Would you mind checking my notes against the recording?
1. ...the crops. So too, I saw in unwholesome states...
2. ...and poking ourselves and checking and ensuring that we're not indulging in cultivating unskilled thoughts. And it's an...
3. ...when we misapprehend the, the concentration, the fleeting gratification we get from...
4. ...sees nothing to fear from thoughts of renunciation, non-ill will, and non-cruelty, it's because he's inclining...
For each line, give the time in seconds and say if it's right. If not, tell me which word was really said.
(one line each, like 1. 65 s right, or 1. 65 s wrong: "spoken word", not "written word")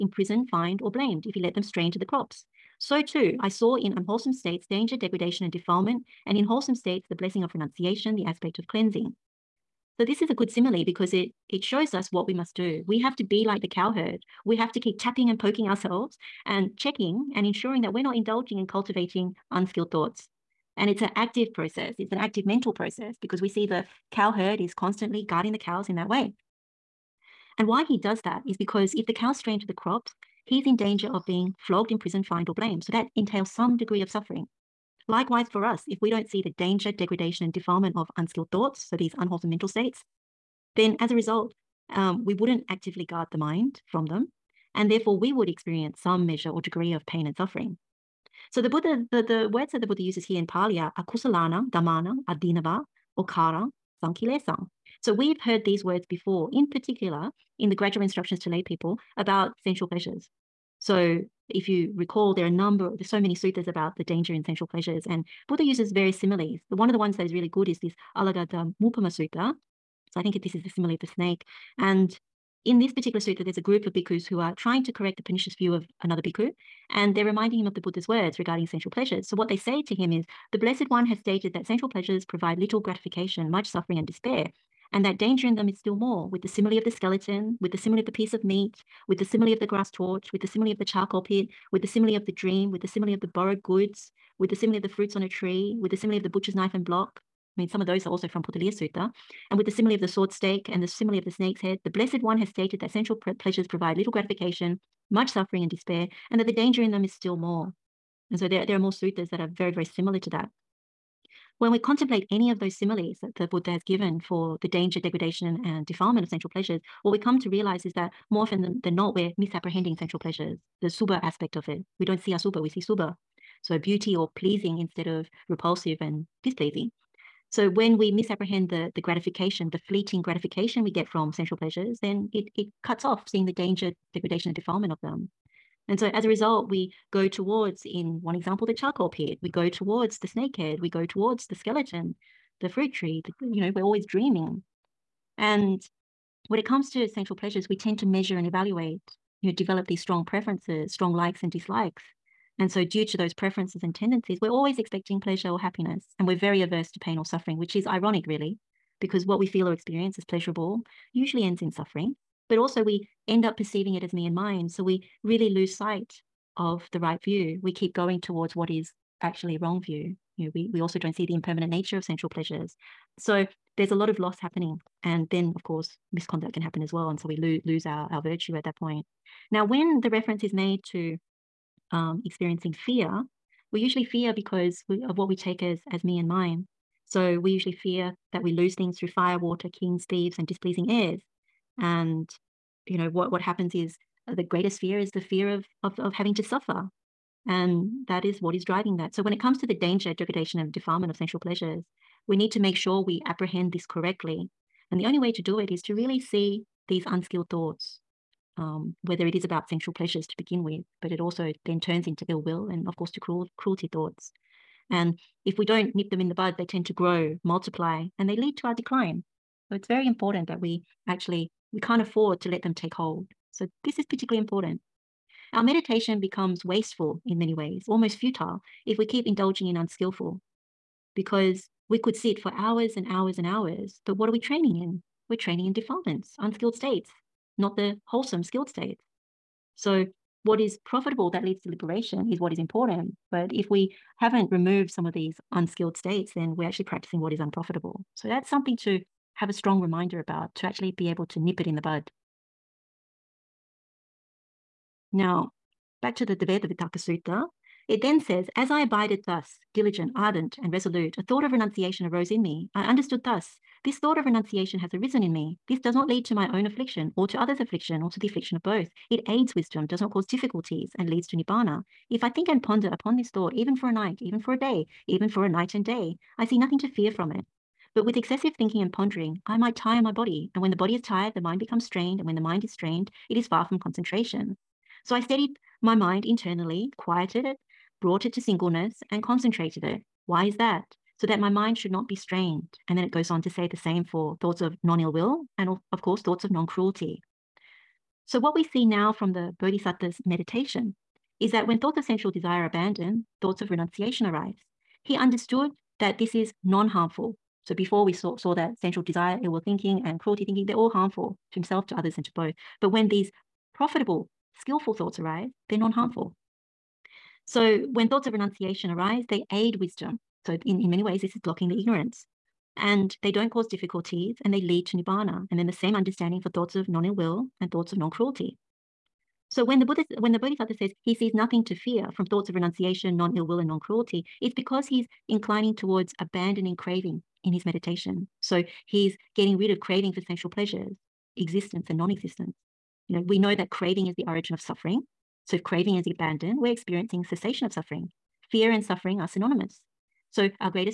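1. 1 s right
2. 15 s right
3. 127 s wrong: "gratification", not "concentration"
4. 331 s right.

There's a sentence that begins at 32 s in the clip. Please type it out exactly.
So that entails some degree of suffering.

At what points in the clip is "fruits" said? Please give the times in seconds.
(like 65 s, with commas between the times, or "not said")
94 s, 142 s.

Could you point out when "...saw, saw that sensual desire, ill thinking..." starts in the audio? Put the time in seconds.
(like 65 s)
308 s.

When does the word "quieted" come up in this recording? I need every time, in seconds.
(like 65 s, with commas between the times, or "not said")
286 s.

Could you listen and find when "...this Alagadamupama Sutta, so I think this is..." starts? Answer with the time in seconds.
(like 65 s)
67 s.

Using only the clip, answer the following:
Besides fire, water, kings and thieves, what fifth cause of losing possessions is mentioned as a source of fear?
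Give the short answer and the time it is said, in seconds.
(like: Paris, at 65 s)
Displeasing heirs, at 190 s.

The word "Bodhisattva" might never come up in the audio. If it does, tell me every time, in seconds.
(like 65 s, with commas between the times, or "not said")
299 s, 330 s.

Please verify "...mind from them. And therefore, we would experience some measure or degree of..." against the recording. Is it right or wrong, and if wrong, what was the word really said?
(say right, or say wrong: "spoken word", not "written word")
right.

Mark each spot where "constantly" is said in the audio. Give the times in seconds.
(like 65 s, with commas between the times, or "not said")
24 s.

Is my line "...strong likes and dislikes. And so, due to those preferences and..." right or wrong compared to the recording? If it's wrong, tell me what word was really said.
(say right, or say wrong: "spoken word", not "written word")
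right.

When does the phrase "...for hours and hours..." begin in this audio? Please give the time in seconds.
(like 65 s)
232 s.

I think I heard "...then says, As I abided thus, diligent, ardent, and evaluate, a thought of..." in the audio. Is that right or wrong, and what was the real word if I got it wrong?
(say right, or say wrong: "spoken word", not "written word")
wrong: "resolute", not "evaluate".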